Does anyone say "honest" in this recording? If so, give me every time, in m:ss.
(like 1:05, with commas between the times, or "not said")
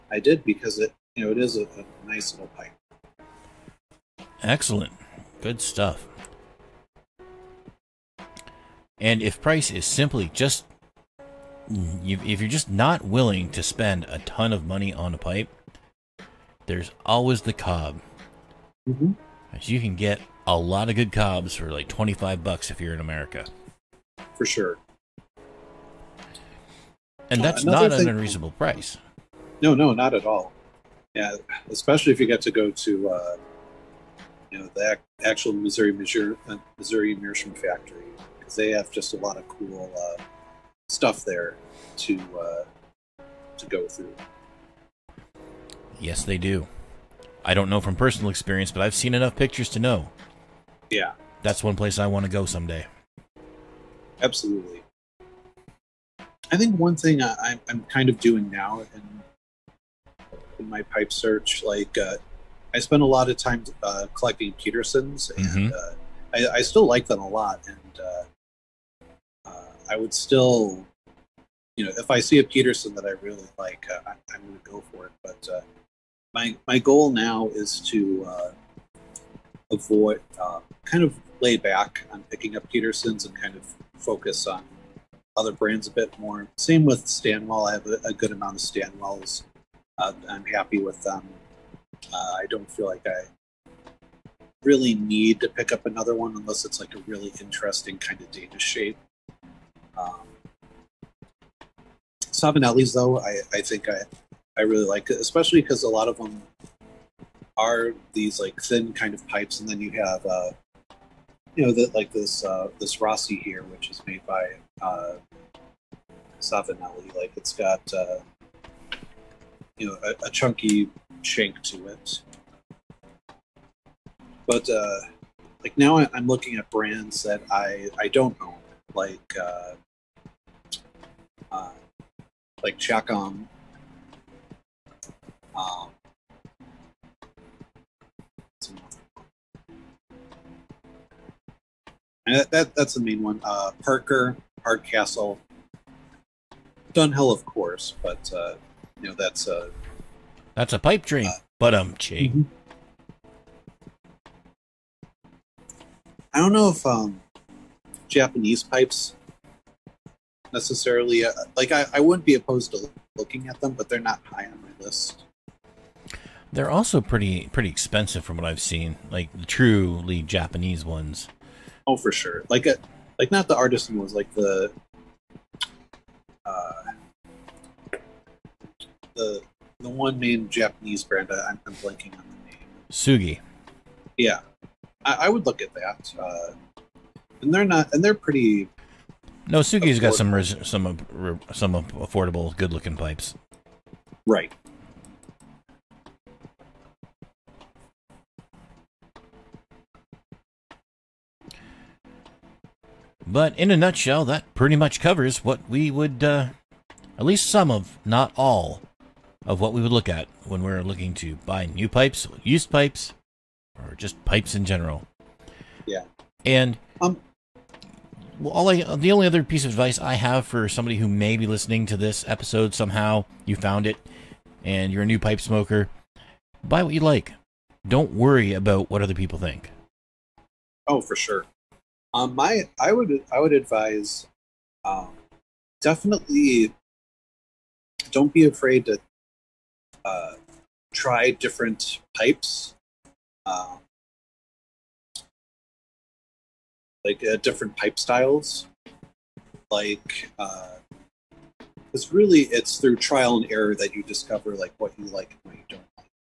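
not said.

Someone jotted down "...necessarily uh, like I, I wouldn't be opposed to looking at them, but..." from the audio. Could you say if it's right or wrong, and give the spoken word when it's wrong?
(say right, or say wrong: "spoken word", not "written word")
right.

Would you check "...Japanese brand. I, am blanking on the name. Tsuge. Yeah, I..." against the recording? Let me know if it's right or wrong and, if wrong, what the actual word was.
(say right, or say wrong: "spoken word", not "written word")
right.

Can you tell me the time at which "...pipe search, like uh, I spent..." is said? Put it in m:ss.
1:00.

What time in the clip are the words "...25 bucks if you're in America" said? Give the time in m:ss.
0:21.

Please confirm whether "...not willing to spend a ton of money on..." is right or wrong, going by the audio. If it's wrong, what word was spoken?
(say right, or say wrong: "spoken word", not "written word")
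right.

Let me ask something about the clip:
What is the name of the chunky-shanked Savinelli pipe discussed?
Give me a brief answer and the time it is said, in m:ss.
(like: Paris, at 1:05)
Rossi, at 1:53.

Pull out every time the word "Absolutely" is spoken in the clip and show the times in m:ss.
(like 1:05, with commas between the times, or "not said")
0:54.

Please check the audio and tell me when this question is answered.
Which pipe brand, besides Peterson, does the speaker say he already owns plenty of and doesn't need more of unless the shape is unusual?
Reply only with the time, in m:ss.
1:27.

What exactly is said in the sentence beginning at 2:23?
Uh, Parker, Hardcastle, Dunhill, of course, but uh, you know that's a uh, that's a pipe dream.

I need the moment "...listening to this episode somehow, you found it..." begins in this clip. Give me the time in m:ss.
3:41.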